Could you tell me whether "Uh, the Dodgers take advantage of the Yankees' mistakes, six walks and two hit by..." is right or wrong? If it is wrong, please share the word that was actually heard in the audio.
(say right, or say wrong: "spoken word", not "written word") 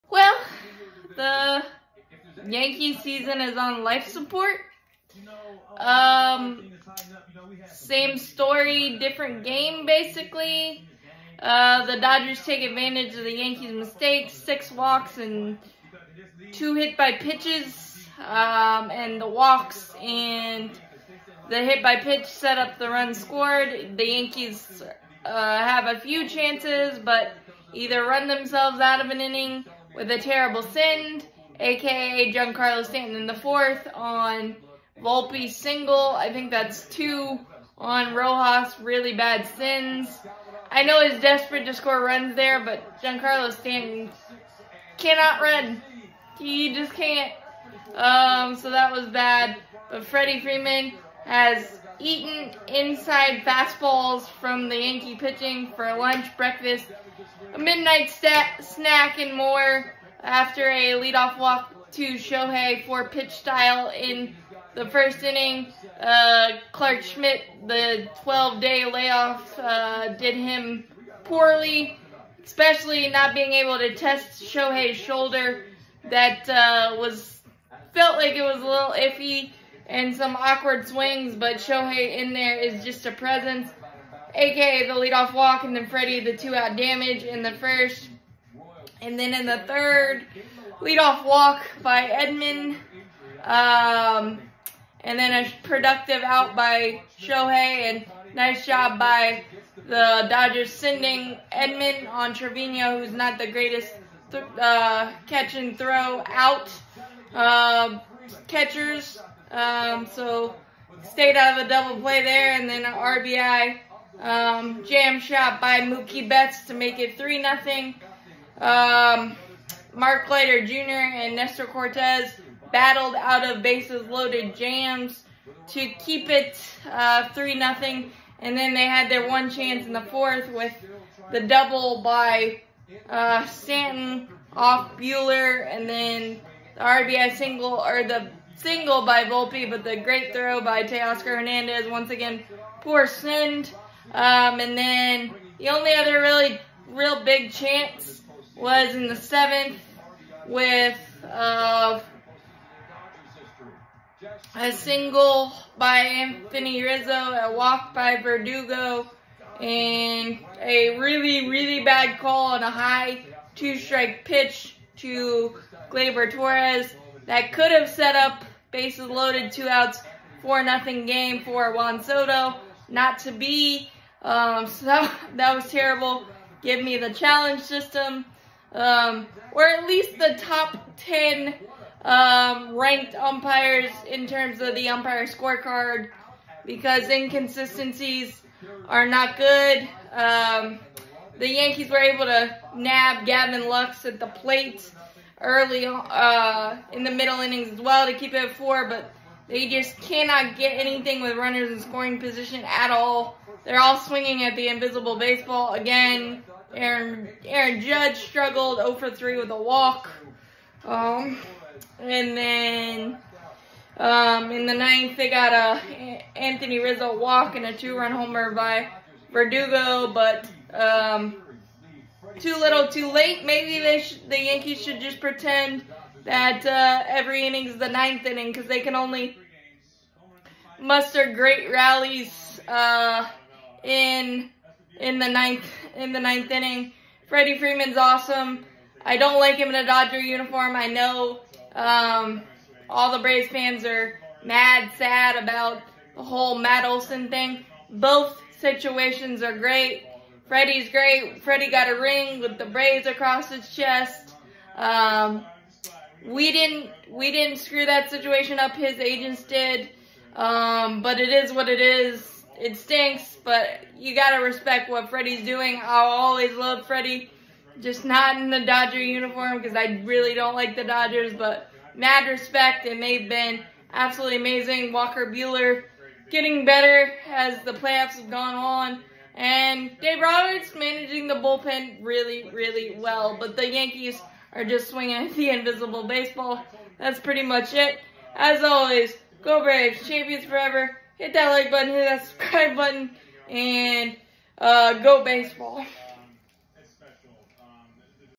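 right.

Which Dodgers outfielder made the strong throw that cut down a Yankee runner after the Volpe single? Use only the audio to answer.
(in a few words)
Teoscar Hernandez.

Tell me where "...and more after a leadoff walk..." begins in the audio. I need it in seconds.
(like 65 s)
59 s.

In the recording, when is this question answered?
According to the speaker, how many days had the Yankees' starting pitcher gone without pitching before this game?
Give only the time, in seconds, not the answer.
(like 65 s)
68 s.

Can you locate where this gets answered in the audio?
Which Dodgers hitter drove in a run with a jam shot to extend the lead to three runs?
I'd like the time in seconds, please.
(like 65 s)
115 s.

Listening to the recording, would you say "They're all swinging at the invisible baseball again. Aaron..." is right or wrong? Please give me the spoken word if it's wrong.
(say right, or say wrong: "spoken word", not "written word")
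right.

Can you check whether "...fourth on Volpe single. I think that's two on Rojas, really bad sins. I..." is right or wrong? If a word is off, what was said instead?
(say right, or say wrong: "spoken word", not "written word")
right.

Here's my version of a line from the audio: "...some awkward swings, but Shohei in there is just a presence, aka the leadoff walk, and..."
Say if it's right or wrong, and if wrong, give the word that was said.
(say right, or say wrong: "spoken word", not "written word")
right.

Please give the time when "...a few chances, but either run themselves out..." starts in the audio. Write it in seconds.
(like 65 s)
25 s.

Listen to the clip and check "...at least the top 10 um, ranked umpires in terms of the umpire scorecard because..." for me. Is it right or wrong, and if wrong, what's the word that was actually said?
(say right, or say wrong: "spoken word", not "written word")
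right.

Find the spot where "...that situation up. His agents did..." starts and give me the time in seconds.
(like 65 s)
257 s.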